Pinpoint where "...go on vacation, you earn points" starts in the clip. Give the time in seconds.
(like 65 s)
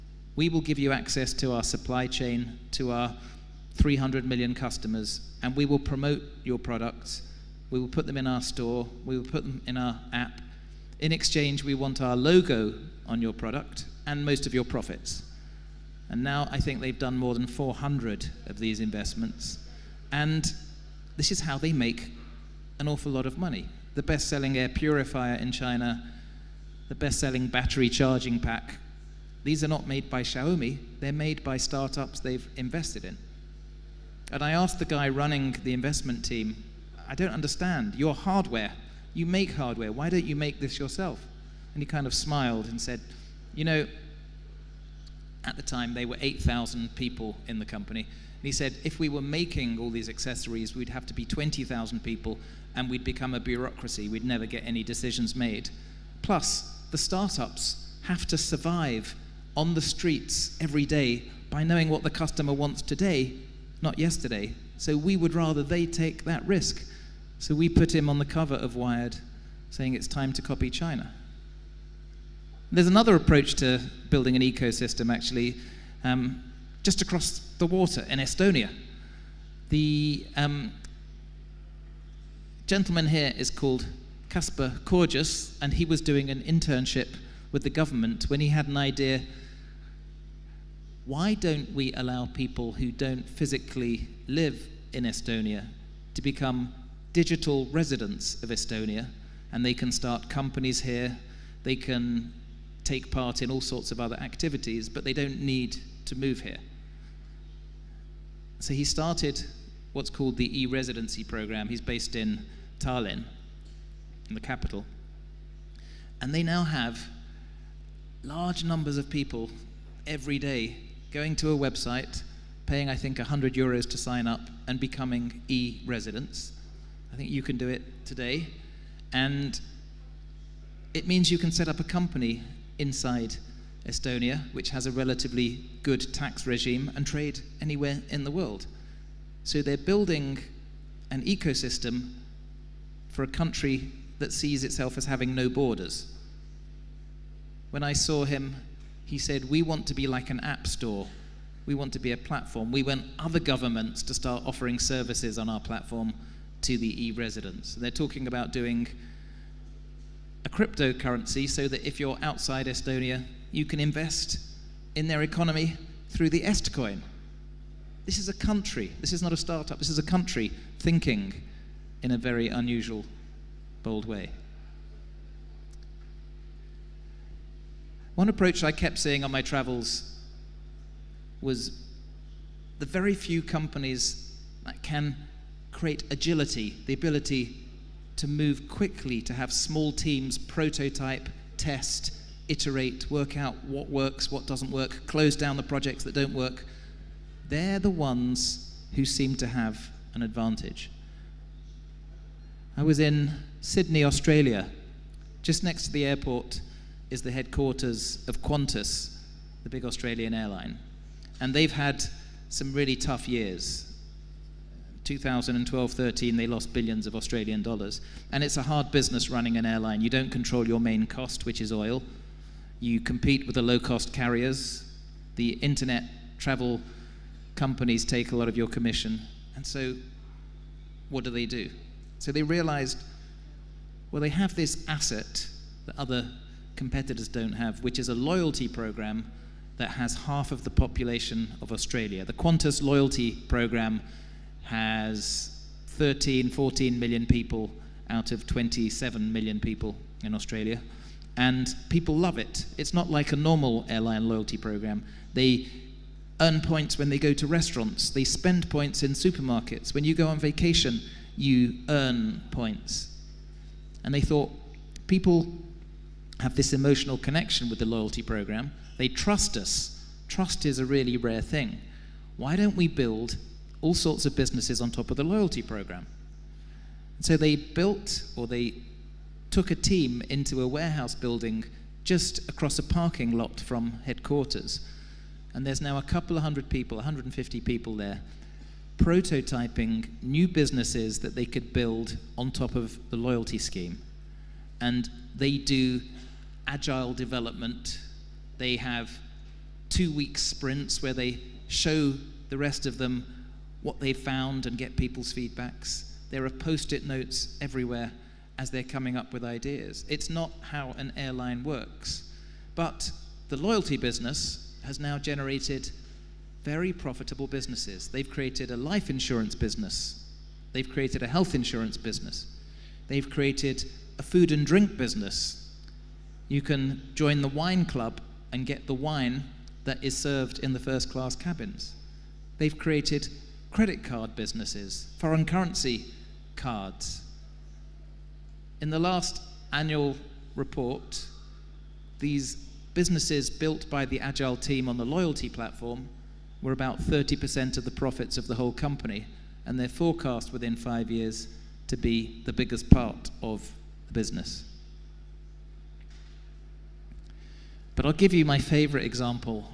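260 s.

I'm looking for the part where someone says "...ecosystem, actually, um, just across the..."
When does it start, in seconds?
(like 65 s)
74 s.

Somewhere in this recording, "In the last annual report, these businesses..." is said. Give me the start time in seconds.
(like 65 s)
338 s.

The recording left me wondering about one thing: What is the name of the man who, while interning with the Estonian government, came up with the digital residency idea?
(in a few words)
Kaspar Korjus.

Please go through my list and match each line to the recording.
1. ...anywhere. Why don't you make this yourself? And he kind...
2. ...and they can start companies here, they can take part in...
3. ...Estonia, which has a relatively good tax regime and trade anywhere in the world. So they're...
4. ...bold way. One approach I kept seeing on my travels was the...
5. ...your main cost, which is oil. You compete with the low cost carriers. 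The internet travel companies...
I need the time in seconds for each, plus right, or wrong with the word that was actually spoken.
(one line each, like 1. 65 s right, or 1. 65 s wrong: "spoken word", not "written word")
1. 39 s wrong: "hardware", not "anywhere"
2. 99 s right
3. 133 s right
4. 173 s right
5. 220 s right.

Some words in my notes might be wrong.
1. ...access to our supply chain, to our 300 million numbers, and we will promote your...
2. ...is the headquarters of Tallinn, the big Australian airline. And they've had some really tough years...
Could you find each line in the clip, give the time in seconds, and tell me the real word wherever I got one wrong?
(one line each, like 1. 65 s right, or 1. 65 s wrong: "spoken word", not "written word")
1. 0 s wrong: "customers", not "numbers"
2. 207 s wrong: "Qantas", not "Tallinn".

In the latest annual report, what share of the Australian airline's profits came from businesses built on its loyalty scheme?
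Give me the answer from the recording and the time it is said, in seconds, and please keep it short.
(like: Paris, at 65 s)
30%, at 347 s.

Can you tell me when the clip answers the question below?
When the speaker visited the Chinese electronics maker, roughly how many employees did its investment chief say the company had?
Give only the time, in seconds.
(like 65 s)
46 s.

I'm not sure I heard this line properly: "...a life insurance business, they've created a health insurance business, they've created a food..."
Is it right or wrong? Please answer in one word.
right.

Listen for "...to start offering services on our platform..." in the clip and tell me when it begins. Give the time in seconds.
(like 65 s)
154 s.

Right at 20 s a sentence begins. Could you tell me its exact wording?
And this is how they make an awful lot of money.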